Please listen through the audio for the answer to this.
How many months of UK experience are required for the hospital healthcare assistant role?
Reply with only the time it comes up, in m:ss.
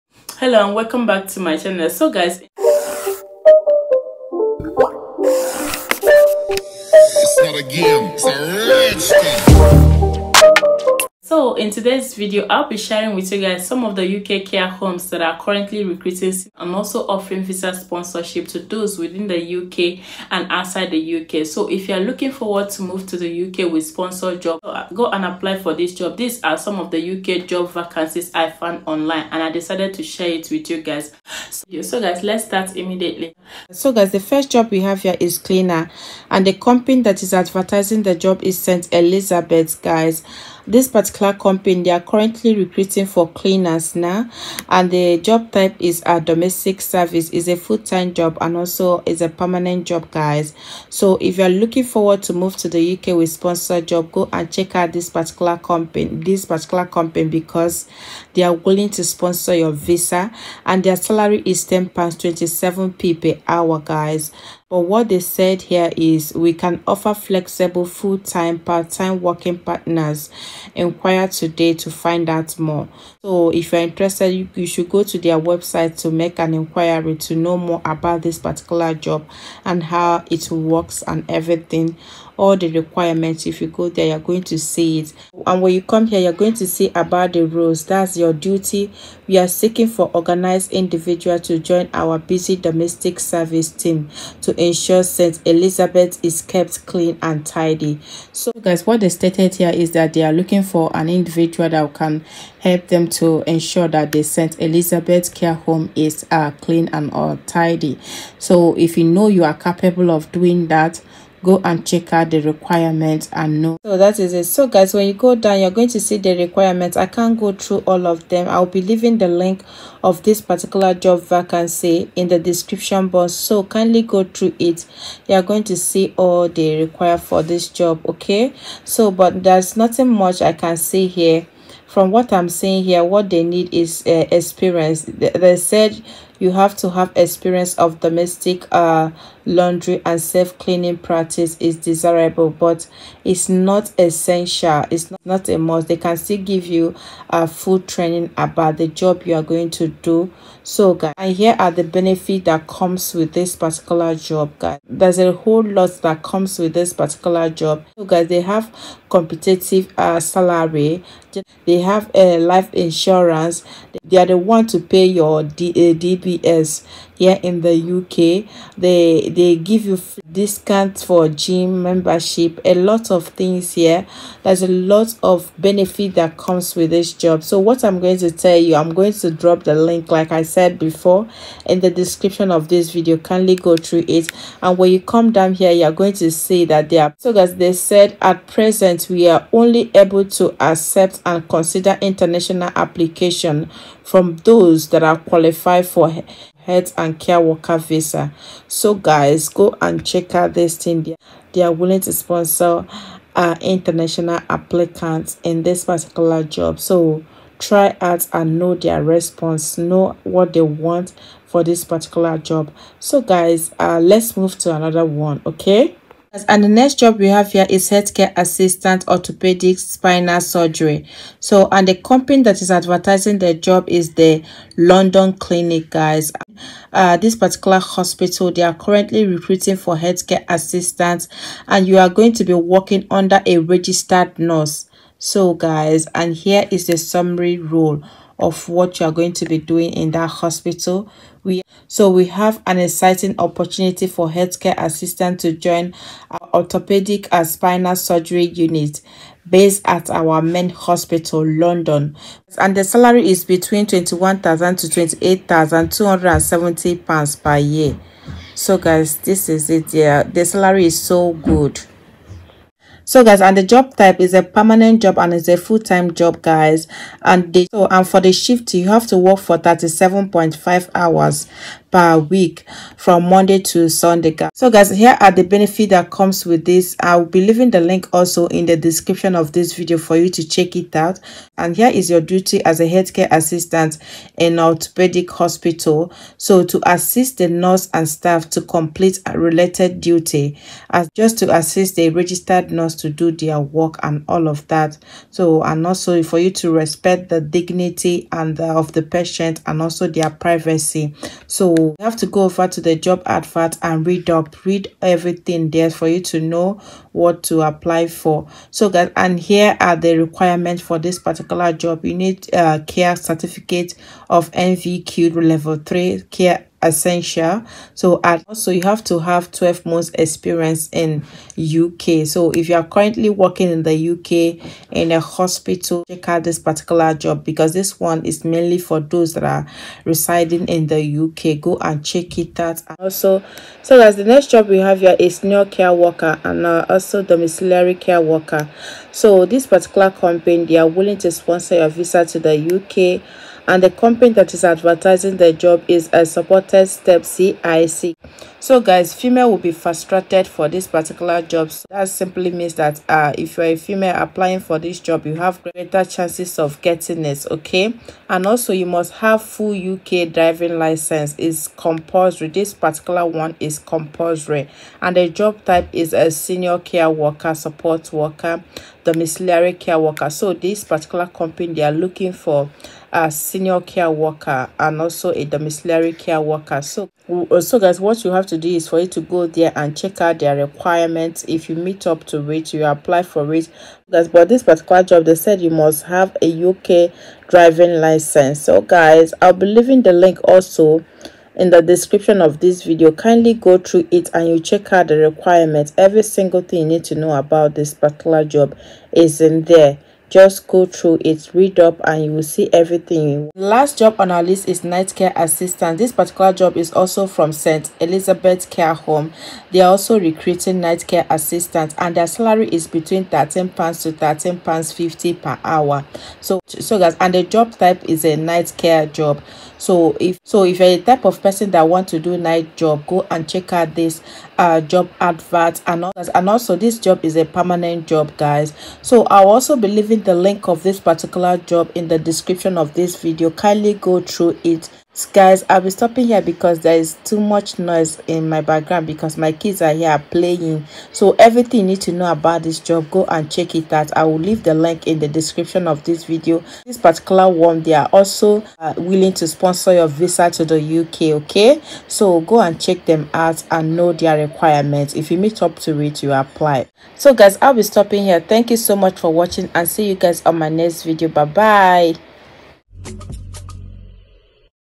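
5:19.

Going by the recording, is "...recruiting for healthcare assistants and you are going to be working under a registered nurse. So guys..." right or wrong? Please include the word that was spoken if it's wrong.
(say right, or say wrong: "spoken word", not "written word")
right.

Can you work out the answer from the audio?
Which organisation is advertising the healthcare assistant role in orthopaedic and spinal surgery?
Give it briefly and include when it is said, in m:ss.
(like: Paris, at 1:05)
The London Clinic, at 3:44.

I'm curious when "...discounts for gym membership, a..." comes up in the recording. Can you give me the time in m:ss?
2:50.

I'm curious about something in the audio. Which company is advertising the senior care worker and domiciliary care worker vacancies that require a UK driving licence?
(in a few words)
Supported Step CIC.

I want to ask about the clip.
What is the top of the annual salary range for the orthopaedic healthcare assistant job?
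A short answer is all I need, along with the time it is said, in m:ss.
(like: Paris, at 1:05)
£28,270, at 4:14.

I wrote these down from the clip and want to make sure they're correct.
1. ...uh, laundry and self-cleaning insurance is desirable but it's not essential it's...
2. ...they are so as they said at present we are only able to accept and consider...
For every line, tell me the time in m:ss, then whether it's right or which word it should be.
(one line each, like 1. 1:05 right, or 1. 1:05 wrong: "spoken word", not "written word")
1. 2:18 wrong: "practice", not "insurance"
2. 3:06 right.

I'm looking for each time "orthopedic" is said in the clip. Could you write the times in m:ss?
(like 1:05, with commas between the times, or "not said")
3:39, 4:06, 4:44.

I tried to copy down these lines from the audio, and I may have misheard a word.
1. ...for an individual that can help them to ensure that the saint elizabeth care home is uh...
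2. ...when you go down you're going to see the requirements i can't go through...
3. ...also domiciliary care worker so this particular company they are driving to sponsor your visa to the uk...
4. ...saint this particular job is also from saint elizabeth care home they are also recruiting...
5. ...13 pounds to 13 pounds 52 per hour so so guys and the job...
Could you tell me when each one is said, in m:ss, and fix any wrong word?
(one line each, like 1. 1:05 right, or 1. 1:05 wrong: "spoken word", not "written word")
1. 1:40 right
2. 1:54 right
3. 5:36 wrong: "willing", not "driving"
4. 6:45 wrong: "assistant", not "saint"
5. 6:53 wrong: "50", not "52".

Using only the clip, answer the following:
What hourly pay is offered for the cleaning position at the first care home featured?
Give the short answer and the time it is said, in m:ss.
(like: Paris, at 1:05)
£10.27 per hour, at 1:01.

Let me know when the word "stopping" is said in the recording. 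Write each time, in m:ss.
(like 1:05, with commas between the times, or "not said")
7:15, 7:37.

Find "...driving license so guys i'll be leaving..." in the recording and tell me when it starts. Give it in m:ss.
6:27.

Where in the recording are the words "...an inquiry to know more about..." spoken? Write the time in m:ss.
1:16.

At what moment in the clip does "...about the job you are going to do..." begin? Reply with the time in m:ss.
2:28.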